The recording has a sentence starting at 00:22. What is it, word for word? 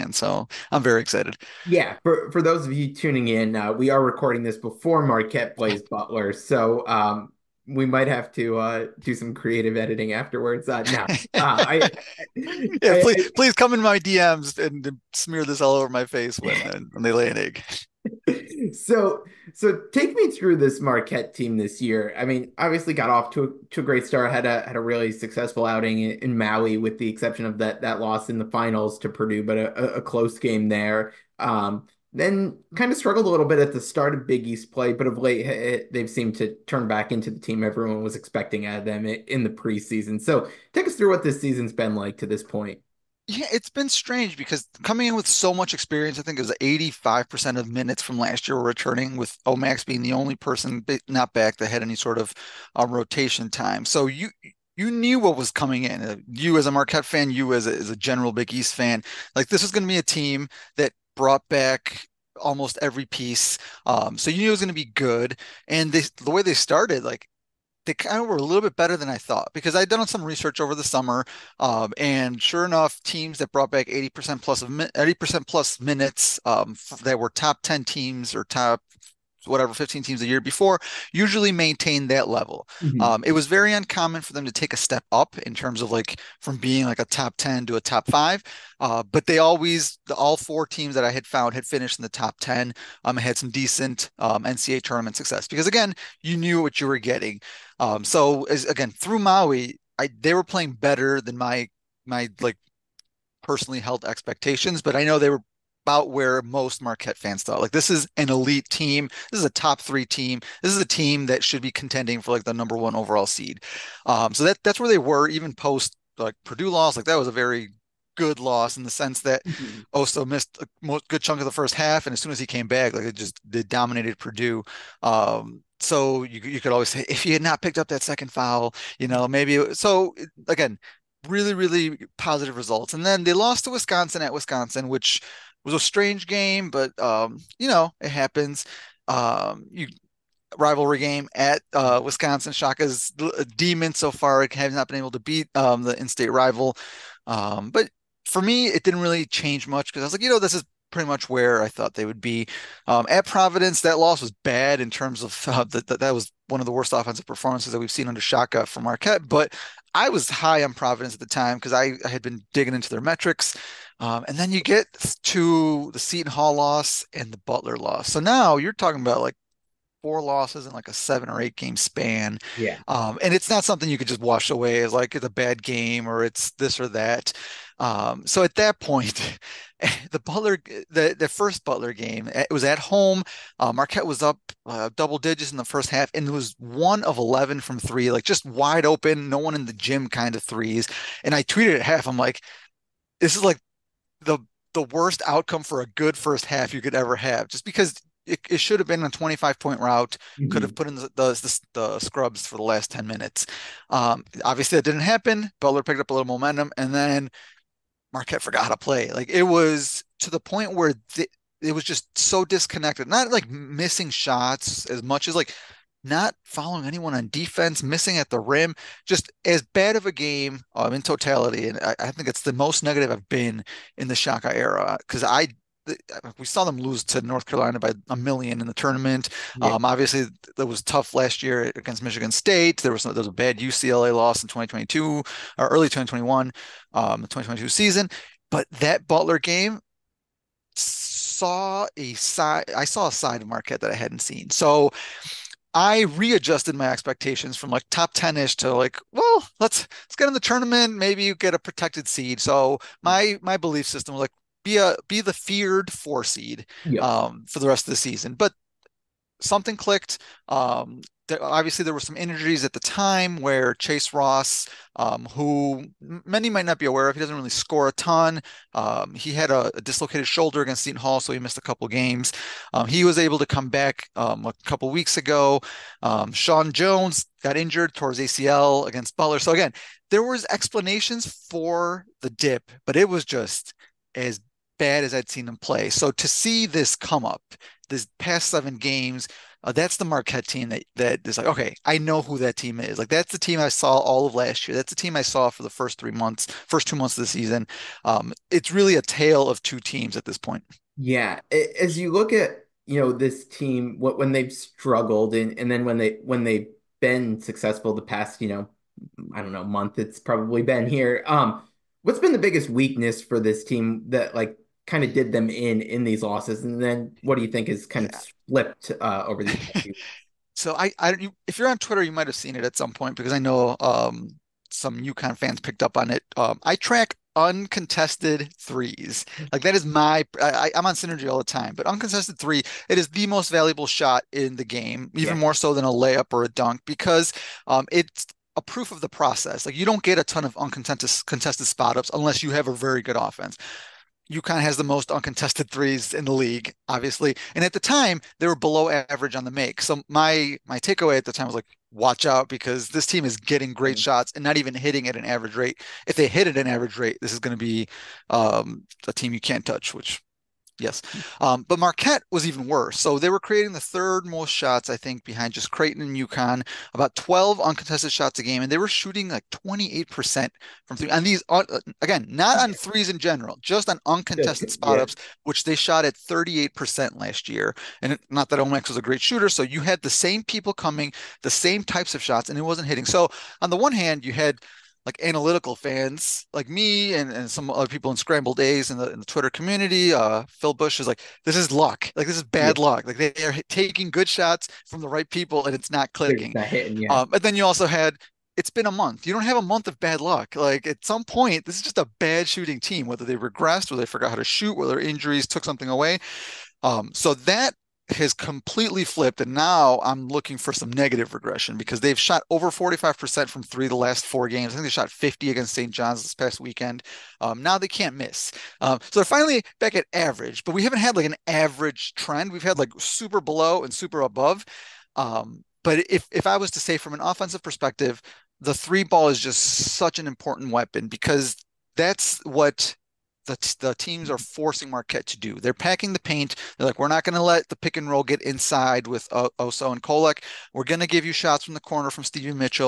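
I mean, obviously got off to a, to a great start.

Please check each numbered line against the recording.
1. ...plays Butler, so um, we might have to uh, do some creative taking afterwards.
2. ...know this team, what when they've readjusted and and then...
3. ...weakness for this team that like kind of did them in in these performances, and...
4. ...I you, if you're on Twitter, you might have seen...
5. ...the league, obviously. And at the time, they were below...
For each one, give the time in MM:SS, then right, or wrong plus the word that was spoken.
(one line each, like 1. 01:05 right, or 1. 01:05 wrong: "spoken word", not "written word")
1. 00:05 wrong: "editing", not "taking"
2. 05:02 wrong: "struggled", not "readjusted"
3. 05:12 wrong: "losses", not "performances"
4. 05:20 right
5. 05:46 right.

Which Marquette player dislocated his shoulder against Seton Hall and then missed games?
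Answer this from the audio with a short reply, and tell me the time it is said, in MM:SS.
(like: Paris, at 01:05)
Chase Ross, at 04:23.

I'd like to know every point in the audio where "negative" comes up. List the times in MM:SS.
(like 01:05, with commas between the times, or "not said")
03:42, 06:50.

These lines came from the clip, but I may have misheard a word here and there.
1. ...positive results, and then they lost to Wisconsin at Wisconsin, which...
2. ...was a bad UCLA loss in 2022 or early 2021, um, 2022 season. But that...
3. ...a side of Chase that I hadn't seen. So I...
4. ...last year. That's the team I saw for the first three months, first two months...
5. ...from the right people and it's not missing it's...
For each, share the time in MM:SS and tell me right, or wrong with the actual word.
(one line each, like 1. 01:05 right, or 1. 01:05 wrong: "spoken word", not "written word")
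1. 02:12 right
2. 03:53 right
3. 04:03 wrong: "Marquette", not "Chase"
4. 04:54 right
5. 06:34 wrong: "clicking", not "missing".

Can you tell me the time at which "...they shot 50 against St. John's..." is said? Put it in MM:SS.
06:54.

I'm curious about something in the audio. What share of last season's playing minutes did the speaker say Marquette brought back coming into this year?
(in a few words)
85%.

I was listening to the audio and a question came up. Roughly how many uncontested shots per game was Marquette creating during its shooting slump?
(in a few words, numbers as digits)
12.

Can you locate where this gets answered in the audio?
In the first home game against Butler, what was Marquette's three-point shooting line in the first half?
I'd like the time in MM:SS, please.
03:06.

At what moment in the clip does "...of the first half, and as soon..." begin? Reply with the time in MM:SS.
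02:01.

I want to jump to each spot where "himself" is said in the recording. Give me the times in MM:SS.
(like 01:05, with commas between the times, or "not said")
not said.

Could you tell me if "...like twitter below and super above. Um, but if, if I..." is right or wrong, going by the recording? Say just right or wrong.
wrong.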